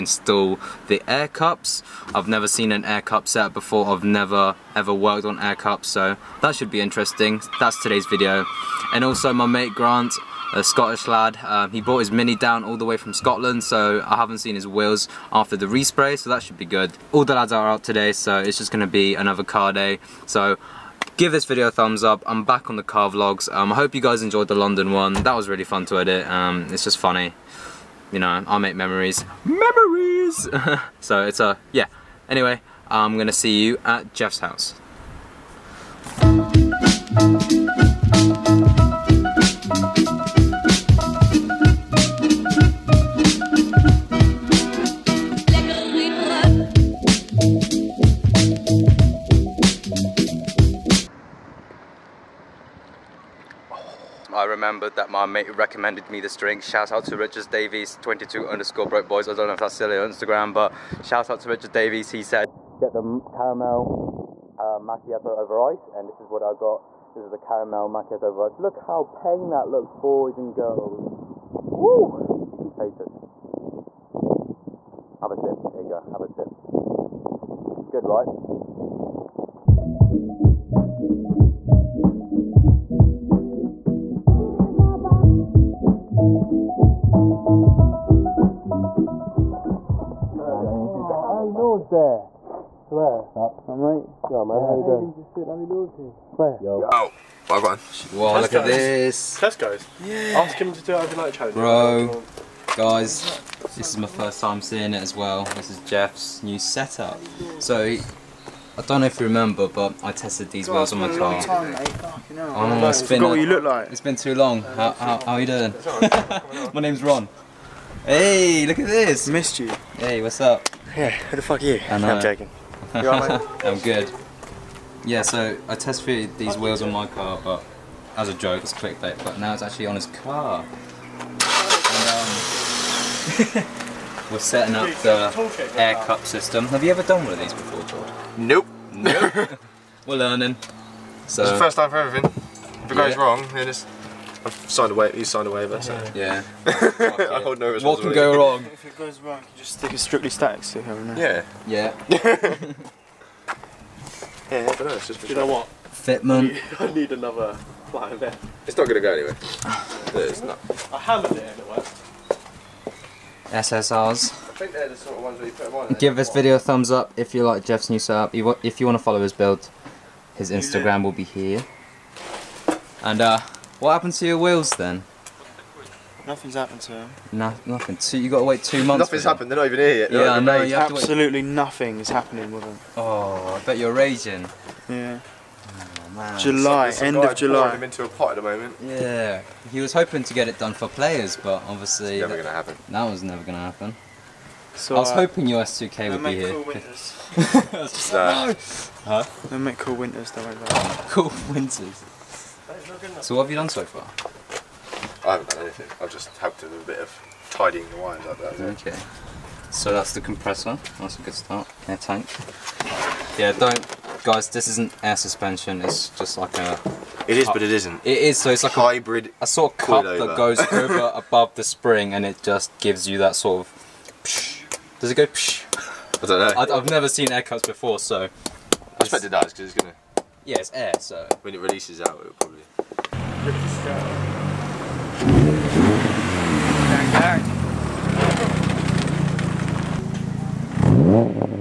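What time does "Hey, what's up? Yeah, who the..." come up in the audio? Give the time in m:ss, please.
1:59.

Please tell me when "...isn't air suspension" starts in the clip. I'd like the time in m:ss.
3:34.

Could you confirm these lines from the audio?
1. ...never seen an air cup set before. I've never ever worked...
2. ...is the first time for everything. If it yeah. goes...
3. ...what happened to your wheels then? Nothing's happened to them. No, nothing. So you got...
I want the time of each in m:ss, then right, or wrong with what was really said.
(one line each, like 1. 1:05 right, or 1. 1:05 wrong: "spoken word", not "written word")
1. 0:02 right
2. 2:21 right
3. 2:53 right.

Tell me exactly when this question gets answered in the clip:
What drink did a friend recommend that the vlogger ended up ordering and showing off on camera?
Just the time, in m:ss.
1:07.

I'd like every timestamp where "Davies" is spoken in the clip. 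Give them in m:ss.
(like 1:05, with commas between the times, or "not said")
0:57, 1:01.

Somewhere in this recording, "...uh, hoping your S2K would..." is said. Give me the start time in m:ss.
3:15.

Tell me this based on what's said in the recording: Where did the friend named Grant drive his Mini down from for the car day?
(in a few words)
Scotland.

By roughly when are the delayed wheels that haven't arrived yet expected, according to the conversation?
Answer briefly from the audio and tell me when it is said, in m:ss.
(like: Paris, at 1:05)
End of July, at 3:07.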